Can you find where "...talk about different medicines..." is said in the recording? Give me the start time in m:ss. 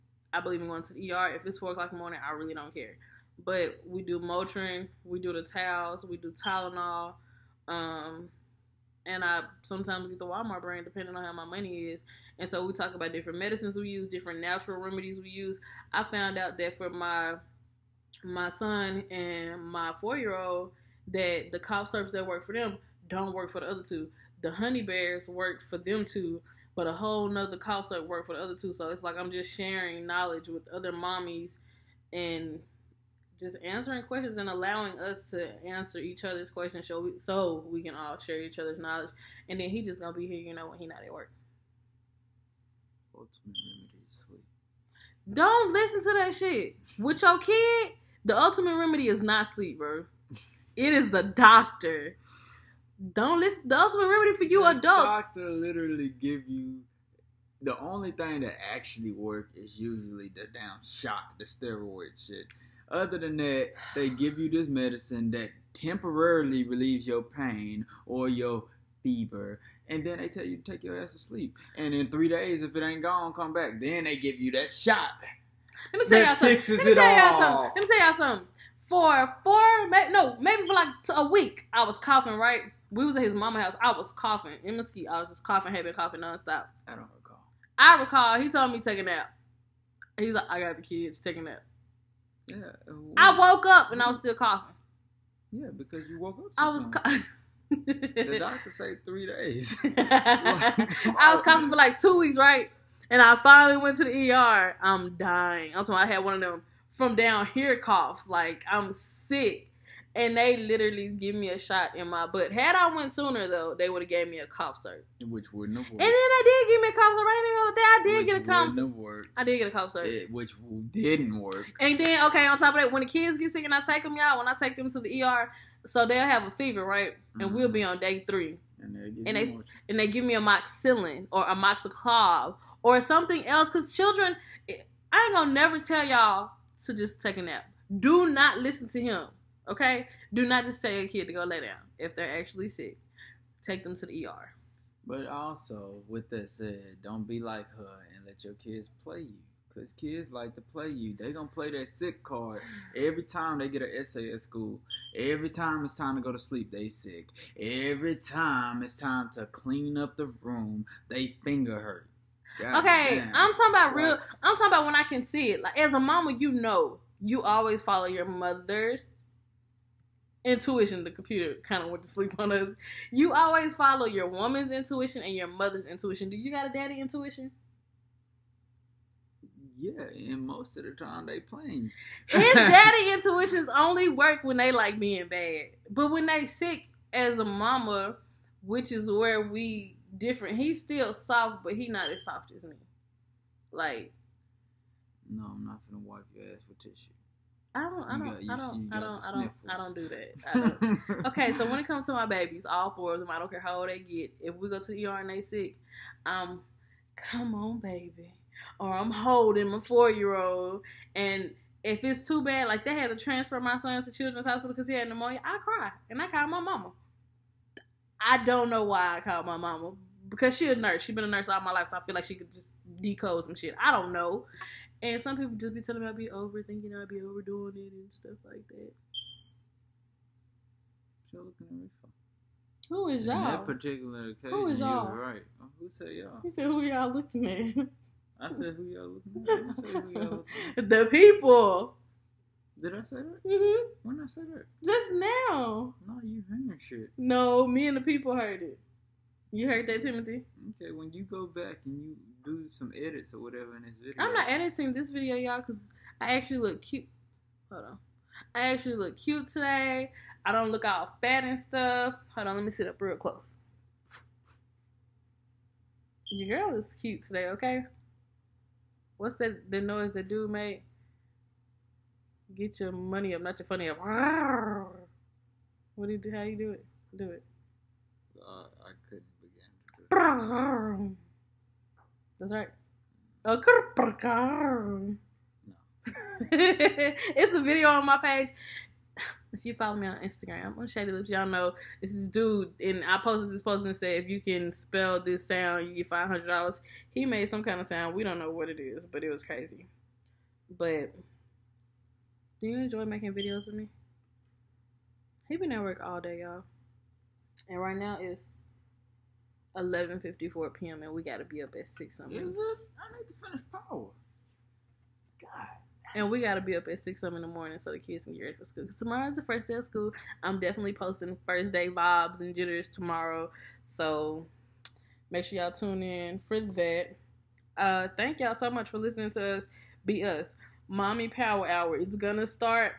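0:12.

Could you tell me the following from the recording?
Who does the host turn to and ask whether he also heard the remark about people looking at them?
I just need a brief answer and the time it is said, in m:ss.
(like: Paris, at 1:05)
Timothy, at 4:10.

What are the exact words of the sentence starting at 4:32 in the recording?
Get your money up, not your funny up.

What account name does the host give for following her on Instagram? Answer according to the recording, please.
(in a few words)
Shady Lips.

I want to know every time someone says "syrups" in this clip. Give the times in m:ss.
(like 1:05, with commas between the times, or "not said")
0:21, 0:27.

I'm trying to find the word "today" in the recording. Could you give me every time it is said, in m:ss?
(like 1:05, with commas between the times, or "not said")
4:19, 4:27.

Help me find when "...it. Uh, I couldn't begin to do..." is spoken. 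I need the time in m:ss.
4:37.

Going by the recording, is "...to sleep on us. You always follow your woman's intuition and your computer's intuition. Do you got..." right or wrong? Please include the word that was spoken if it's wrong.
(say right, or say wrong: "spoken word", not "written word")
wrong: "mother", not "computer".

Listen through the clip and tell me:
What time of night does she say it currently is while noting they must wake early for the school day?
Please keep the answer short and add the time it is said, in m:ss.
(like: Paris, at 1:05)
11:54 p.m., at 5:09.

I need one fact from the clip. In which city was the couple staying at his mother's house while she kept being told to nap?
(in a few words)
Mesquite.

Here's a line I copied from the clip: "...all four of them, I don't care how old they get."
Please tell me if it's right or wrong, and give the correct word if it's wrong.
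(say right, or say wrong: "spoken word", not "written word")
right.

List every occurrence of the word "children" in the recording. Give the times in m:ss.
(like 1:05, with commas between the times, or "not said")
2:13, 3:34.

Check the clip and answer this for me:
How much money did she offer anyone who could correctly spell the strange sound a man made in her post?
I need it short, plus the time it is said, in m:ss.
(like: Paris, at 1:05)
$500, at 4:56.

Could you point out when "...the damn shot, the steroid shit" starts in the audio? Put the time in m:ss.
1:00.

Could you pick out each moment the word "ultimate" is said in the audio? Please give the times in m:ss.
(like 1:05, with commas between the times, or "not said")
0:43, 0:48, 0:53.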